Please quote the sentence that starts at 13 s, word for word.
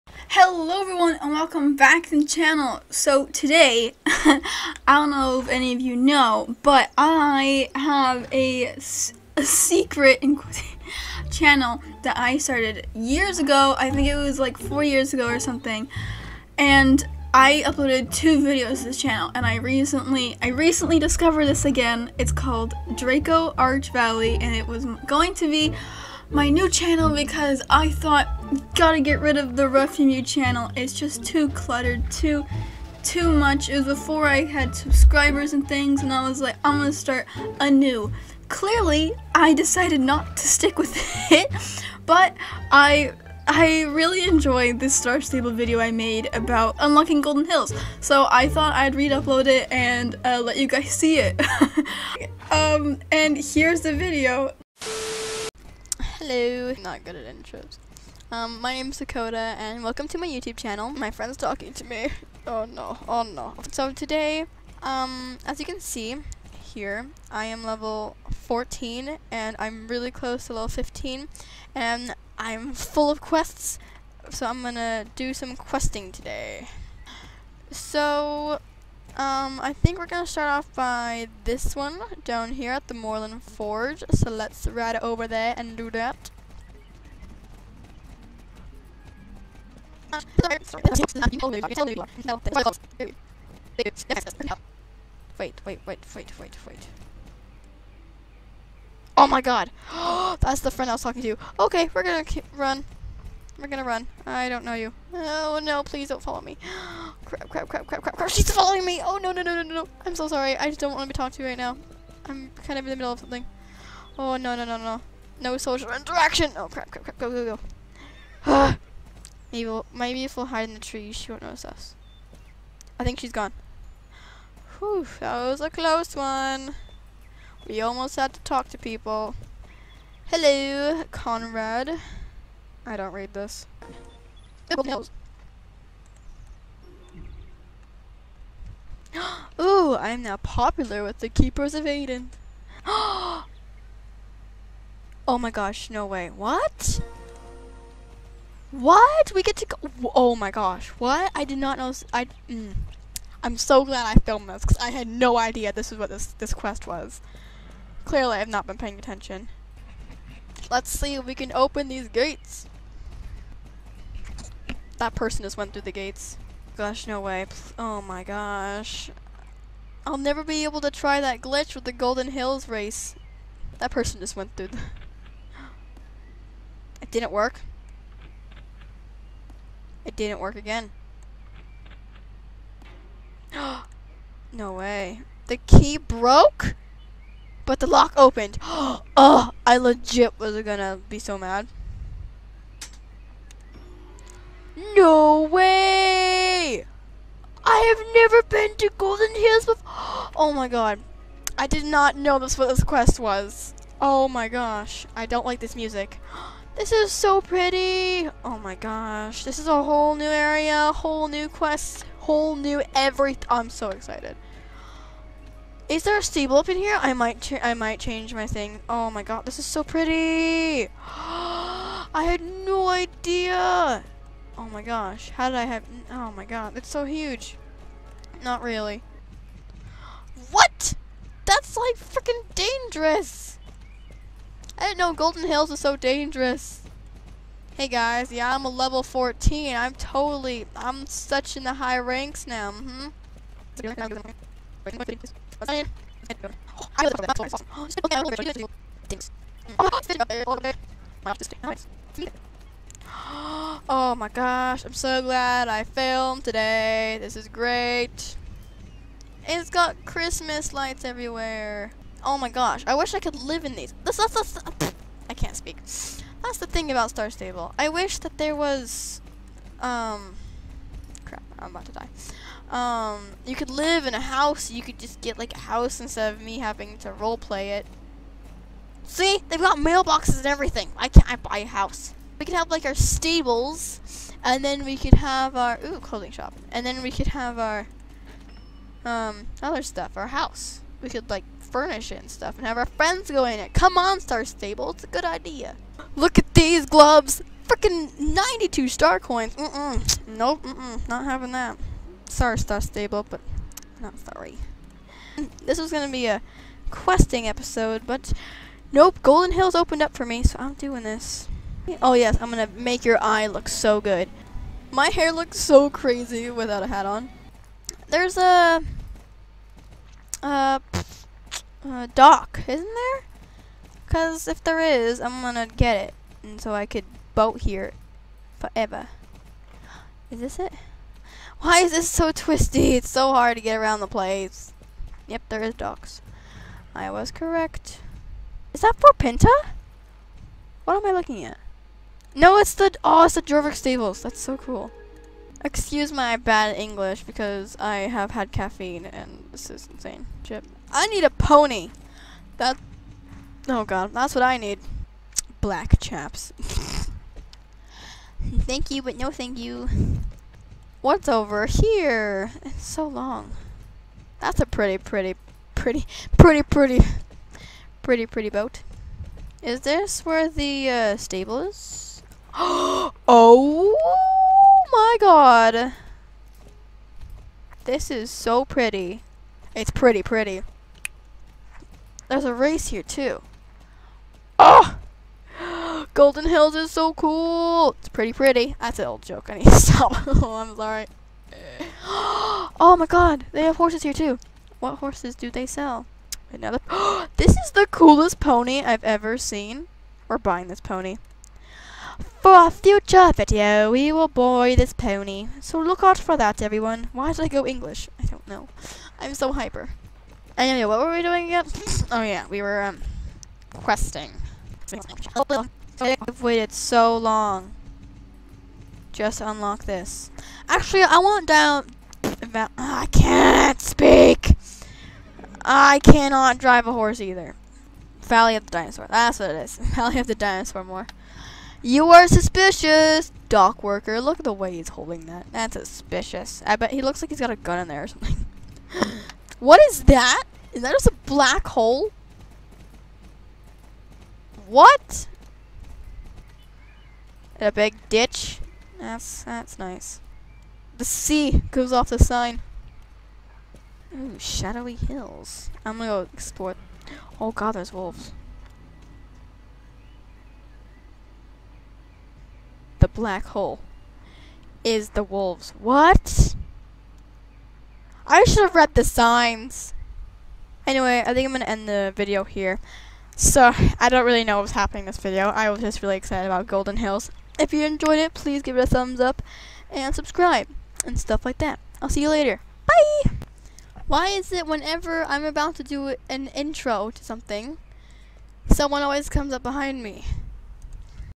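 I think it was like four years ago or something.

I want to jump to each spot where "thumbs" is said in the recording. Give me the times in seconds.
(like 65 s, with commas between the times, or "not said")
478 s.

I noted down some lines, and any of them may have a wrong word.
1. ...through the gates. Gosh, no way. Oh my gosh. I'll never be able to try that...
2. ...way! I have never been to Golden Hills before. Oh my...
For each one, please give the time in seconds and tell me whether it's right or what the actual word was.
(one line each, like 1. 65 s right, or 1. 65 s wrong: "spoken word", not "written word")
1. 165 s right
2. 195 s right.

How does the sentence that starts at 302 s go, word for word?
Sorry, Star Stable, but not sorry.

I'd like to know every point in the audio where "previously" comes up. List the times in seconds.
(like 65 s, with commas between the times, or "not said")
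not said.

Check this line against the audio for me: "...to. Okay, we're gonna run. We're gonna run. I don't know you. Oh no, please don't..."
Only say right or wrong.
right.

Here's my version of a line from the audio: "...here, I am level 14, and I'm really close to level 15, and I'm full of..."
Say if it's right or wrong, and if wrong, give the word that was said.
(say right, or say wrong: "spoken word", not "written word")
right.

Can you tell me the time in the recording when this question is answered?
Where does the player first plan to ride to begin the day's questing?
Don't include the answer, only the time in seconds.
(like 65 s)
82 s.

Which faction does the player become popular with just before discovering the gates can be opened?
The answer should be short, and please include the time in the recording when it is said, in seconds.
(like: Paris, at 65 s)
Keepers of Aideen, at 141 s.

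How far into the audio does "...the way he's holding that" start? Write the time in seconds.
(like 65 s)
434 s.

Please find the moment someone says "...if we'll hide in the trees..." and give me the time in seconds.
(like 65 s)
120 s.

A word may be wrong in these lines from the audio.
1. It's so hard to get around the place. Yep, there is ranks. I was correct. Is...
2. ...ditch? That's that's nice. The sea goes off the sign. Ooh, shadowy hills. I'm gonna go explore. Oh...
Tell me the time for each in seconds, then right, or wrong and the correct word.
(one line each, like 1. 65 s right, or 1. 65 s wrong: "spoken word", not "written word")
1. 332 s wrong: "docks", not "ranks"
2. 448 s right.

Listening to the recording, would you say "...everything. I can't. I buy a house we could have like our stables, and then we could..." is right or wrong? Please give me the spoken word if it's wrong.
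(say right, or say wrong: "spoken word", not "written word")
right.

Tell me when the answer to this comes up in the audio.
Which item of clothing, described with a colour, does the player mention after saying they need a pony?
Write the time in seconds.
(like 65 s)
355 s.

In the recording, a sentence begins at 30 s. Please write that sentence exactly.
It's just too cluttered, too too much.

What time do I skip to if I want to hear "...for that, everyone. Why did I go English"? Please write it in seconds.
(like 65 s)
406 s.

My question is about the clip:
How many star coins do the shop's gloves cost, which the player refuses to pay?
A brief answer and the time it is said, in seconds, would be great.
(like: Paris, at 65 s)
92, at 298 s.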